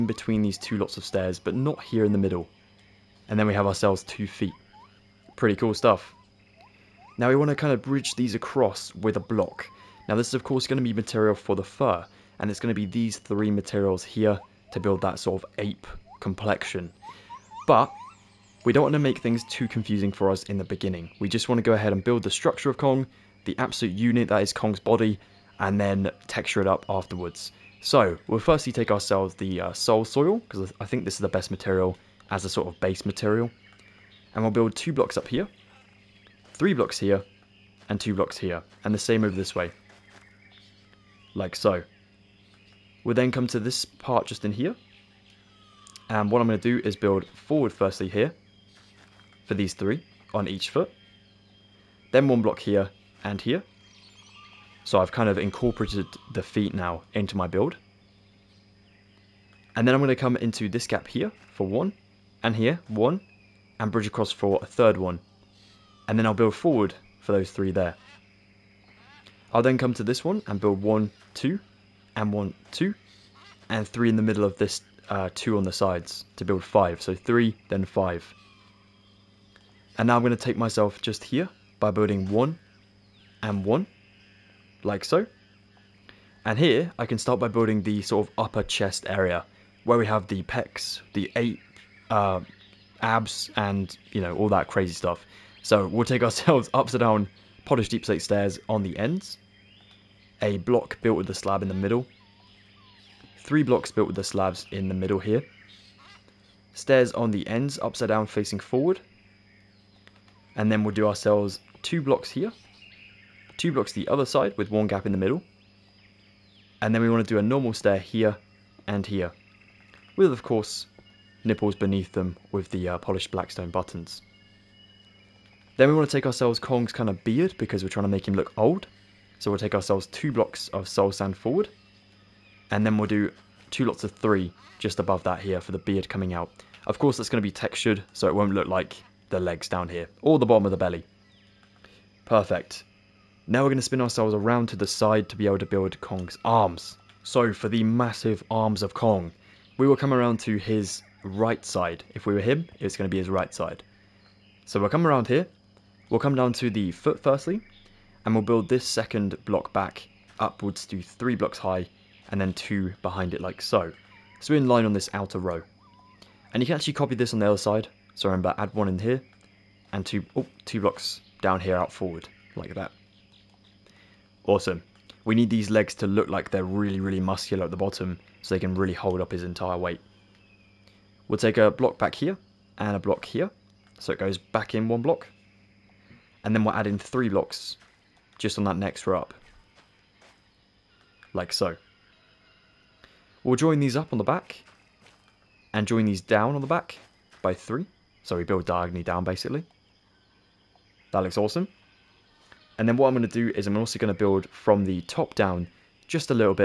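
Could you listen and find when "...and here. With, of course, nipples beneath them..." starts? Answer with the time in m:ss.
1:58.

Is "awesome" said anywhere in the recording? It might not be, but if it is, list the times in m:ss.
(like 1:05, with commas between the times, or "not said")
2:54, 3:21.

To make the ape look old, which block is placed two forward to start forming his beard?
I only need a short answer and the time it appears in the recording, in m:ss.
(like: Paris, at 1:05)
soul sand, at 2:10.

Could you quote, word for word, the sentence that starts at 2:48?
So remember, add one in here, and two, oh, two blocks down here out forward, like that.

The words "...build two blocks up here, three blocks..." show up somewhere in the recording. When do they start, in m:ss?
0:34.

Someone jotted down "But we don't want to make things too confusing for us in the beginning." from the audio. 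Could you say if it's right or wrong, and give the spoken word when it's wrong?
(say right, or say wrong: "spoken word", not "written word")
right.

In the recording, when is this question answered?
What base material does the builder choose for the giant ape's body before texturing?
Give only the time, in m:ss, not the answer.
0:29.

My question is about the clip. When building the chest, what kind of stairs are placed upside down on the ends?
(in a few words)
polished deepslate stairs.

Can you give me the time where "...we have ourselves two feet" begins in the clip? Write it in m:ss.
0:03.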